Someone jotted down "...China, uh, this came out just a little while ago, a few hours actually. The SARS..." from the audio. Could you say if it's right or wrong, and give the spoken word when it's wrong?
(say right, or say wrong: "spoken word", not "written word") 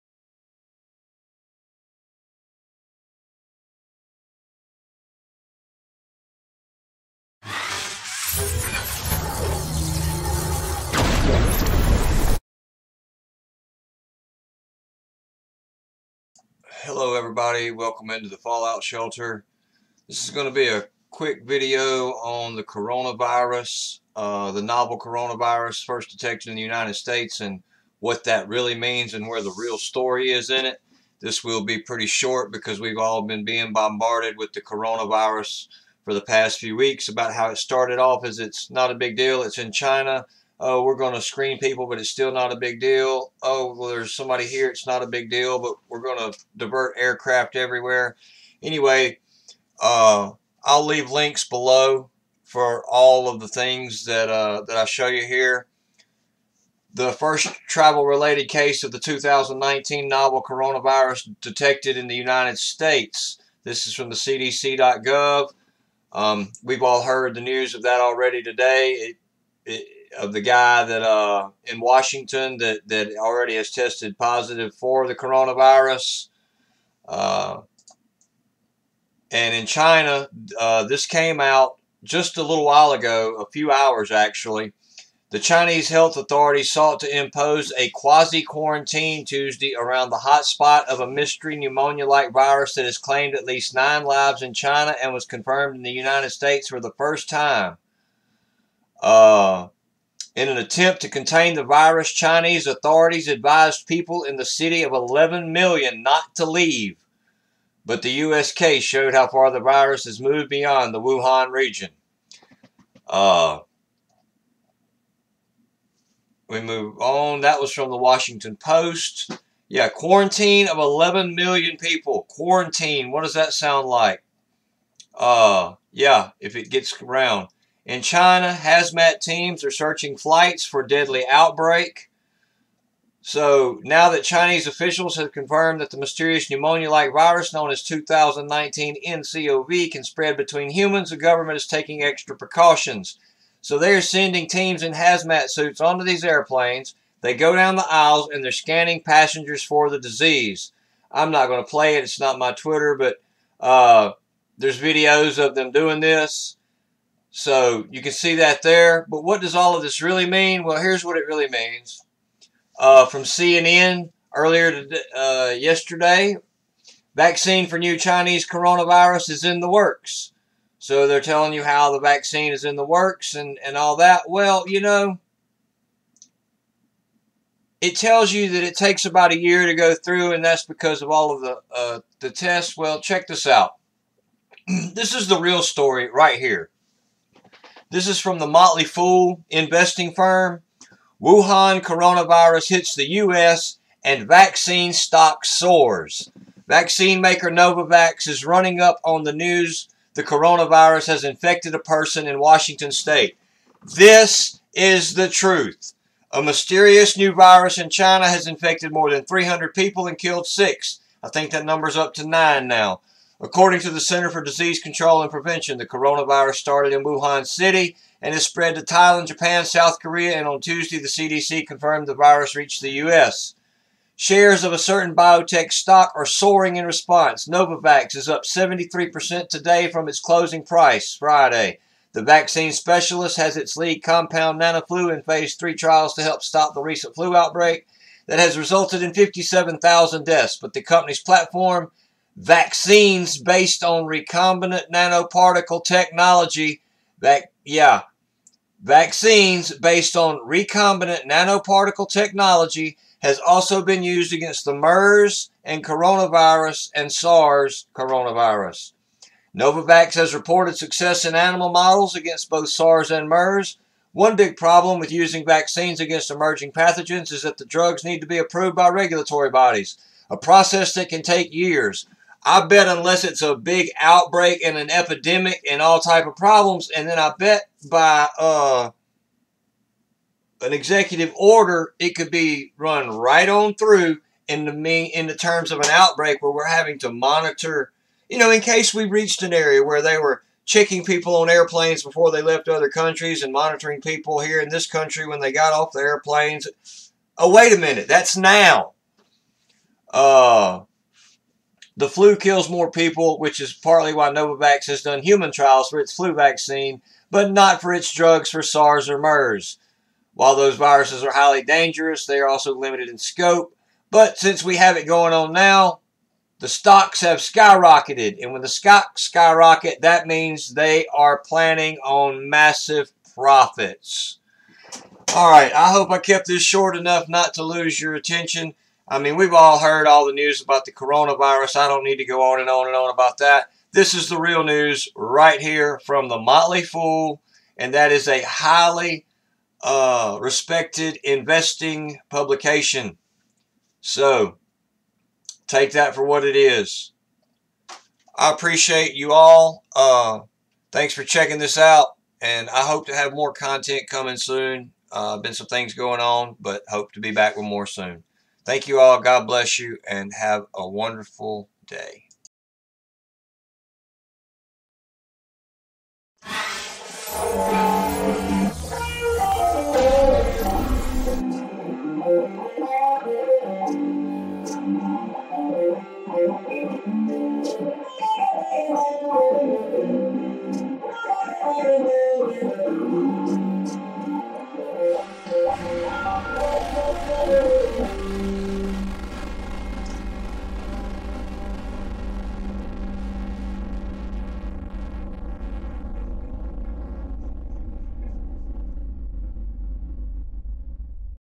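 wrong: "Chinese", not "SARS".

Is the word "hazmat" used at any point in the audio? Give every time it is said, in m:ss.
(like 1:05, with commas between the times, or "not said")
2:08, 2:24.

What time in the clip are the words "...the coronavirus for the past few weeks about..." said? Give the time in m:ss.
0:34.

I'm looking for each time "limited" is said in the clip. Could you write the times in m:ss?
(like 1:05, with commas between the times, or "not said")
5:12.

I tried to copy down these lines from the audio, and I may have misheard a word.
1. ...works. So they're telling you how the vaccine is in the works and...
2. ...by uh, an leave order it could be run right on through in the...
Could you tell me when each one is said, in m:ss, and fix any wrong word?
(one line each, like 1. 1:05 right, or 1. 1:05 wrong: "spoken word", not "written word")
1. 2:49 right
2. 4:37 wrong: "executive", not "leave".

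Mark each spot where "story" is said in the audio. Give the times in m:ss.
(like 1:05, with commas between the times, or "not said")
0:29, 3:05.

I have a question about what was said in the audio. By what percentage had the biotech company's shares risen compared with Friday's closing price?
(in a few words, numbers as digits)
73%.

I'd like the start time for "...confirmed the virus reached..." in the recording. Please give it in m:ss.
3:41.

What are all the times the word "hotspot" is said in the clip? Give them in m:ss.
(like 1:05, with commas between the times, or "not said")
1:30.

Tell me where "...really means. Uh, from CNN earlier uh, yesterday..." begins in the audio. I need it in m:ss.
2:41.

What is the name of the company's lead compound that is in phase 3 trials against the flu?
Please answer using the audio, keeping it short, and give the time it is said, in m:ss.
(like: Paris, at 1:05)
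Nanoflu, at 3:54.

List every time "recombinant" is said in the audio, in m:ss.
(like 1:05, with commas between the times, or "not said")
4:04, 4:10.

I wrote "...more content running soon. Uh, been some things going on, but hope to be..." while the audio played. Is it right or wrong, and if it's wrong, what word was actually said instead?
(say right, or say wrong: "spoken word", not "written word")
wrong: "coming", not "running".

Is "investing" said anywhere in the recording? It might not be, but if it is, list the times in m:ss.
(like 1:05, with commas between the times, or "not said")
3:09, 5:41.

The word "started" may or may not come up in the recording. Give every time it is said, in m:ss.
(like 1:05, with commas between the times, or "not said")
0:37, 3:36.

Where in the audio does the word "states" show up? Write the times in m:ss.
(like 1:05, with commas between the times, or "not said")
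0:26, 1:02, 1:36, 3:22.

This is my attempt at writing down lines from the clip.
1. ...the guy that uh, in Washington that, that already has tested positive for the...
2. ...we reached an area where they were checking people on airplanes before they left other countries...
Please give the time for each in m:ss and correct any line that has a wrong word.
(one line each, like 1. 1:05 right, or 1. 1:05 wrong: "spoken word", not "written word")
1. 1:10 right
2. 4:48 right.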